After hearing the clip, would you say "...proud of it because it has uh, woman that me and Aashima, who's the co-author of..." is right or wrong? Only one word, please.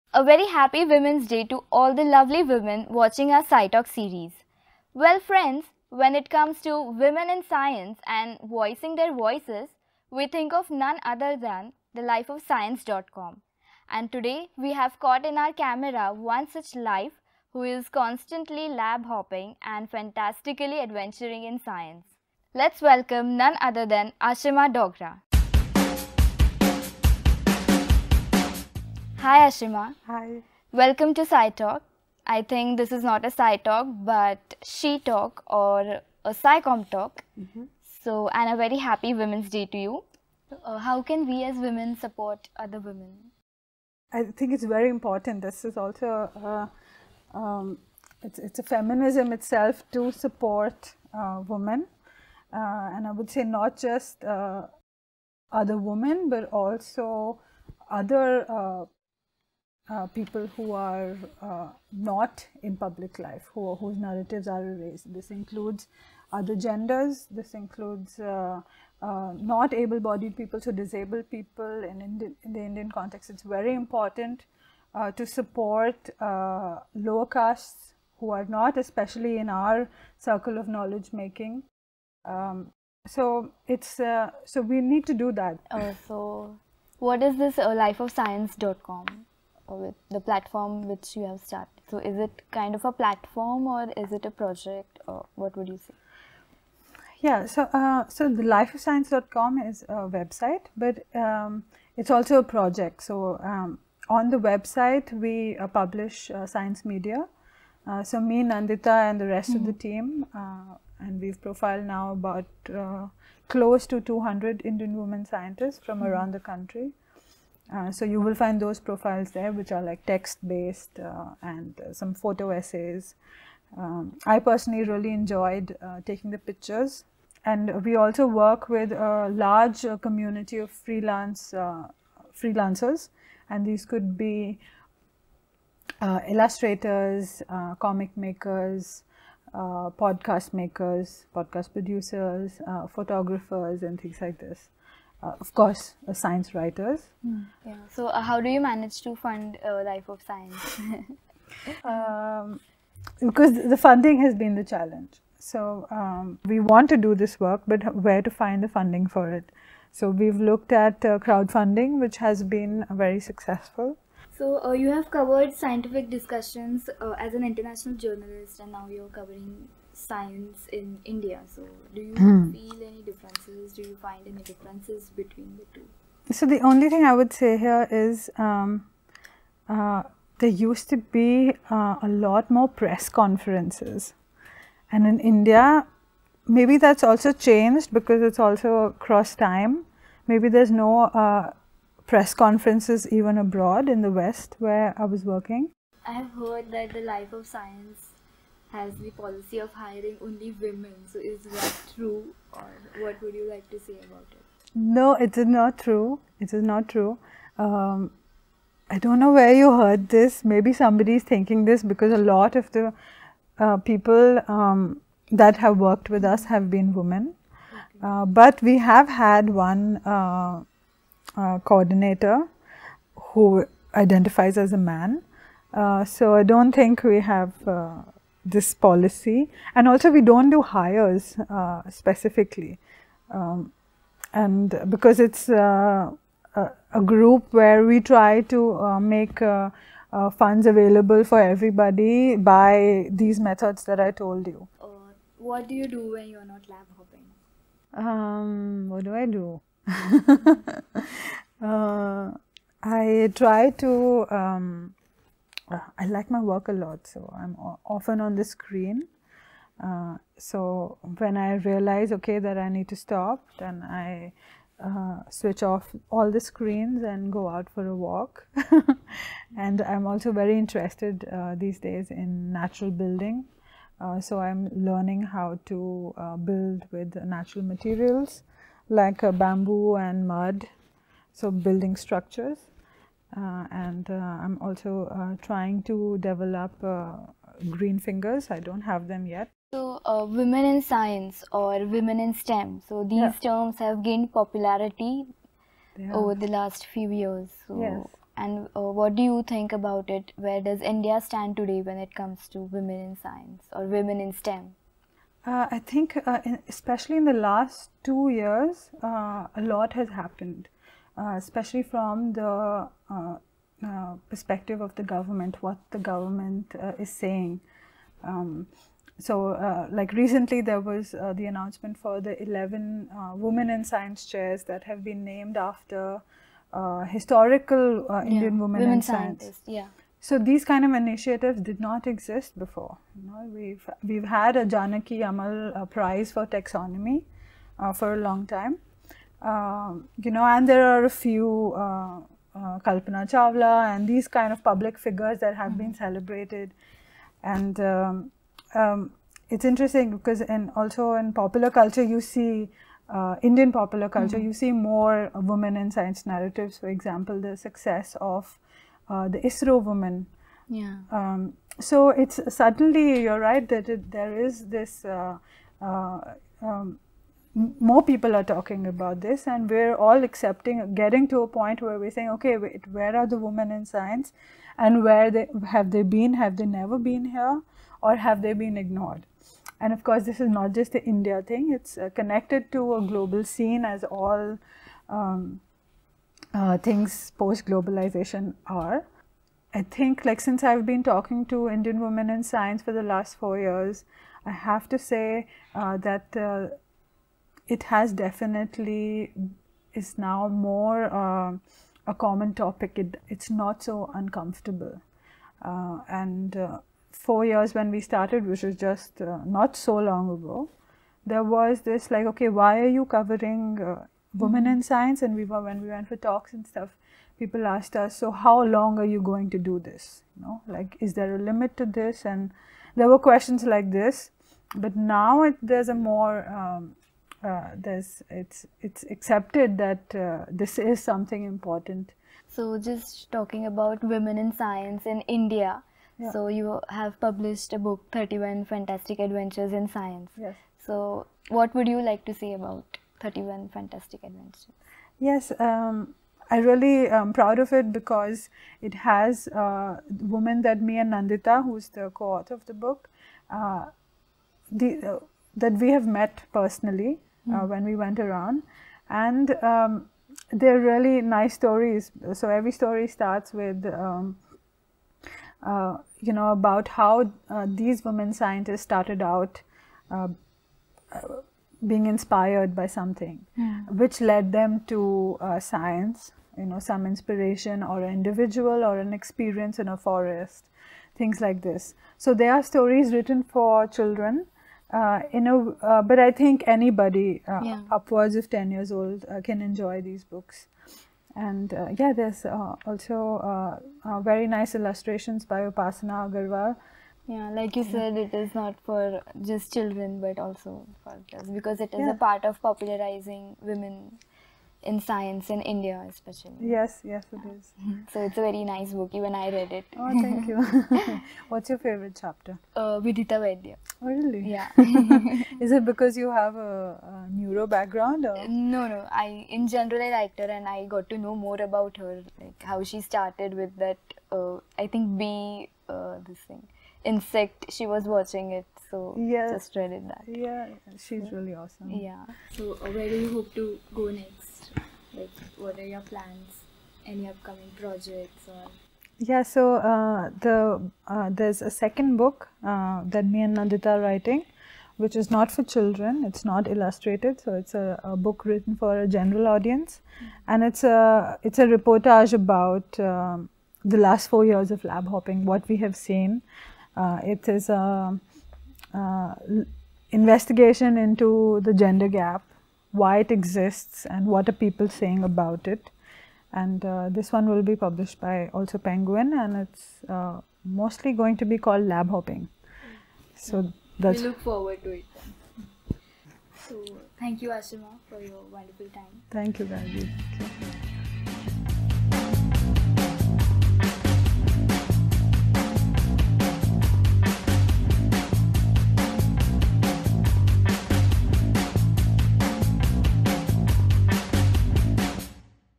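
wrong.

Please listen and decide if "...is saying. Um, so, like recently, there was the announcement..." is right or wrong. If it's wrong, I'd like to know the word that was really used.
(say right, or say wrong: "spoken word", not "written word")
right.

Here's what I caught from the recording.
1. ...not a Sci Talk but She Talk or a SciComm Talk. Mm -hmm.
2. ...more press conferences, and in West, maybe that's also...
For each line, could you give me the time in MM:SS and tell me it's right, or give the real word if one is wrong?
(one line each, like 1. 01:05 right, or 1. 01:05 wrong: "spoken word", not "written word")
1. 00:33 right
2. 03:02 wrong: "India", not "West".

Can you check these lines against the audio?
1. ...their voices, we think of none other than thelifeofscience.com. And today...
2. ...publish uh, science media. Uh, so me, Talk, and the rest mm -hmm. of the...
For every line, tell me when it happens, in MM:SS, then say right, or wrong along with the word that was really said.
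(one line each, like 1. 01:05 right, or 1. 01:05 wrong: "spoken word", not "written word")
1. 00:08 right
2. 01:45 wrong: "Nandita", not "Talk".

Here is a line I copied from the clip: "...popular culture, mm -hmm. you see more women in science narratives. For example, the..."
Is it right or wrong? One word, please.
right.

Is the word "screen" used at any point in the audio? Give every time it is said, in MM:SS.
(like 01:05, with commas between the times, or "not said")
04:18, 04:26.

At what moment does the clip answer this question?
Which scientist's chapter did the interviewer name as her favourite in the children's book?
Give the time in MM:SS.
08:32.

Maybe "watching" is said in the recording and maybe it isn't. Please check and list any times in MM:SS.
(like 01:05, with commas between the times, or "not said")
00:02, 08:48.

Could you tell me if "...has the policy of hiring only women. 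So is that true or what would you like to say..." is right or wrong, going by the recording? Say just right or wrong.
right.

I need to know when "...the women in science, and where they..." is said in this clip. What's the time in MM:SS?
06:13.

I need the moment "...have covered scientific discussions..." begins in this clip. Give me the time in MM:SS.
02:44.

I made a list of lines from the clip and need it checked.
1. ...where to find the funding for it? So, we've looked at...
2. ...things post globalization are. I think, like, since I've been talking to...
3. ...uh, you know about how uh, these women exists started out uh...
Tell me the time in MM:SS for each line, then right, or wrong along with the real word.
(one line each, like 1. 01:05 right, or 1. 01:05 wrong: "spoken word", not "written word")
1. 02:37 right
2. 06:26 right
3. 07:45 wrong: "scientists", not "exists".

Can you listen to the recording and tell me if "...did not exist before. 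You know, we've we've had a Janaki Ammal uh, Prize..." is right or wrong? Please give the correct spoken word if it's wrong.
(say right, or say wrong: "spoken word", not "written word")
right.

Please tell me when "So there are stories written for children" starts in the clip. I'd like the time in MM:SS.
08:02.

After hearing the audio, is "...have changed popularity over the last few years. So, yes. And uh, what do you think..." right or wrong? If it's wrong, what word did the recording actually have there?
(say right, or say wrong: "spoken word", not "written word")
wrong: "gained", not "changed".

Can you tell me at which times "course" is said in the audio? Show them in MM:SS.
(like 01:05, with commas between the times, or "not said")
02:25, 06:20.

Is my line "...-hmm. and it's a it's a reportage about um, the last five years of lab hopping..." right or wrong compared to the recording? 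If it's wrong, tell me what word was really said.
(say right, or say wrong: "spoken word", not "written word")
wrong: "four", not "five".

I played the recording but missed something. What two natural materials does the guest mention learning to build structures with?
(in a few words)
bamboo and mud.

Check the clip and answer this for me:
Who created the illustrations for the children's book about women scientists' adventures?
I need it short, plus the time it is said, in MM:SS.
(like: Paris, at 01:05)
Upasana Agarwal, at 08:15.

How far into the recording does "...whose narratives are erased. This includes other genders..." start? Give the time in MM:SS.
01:03.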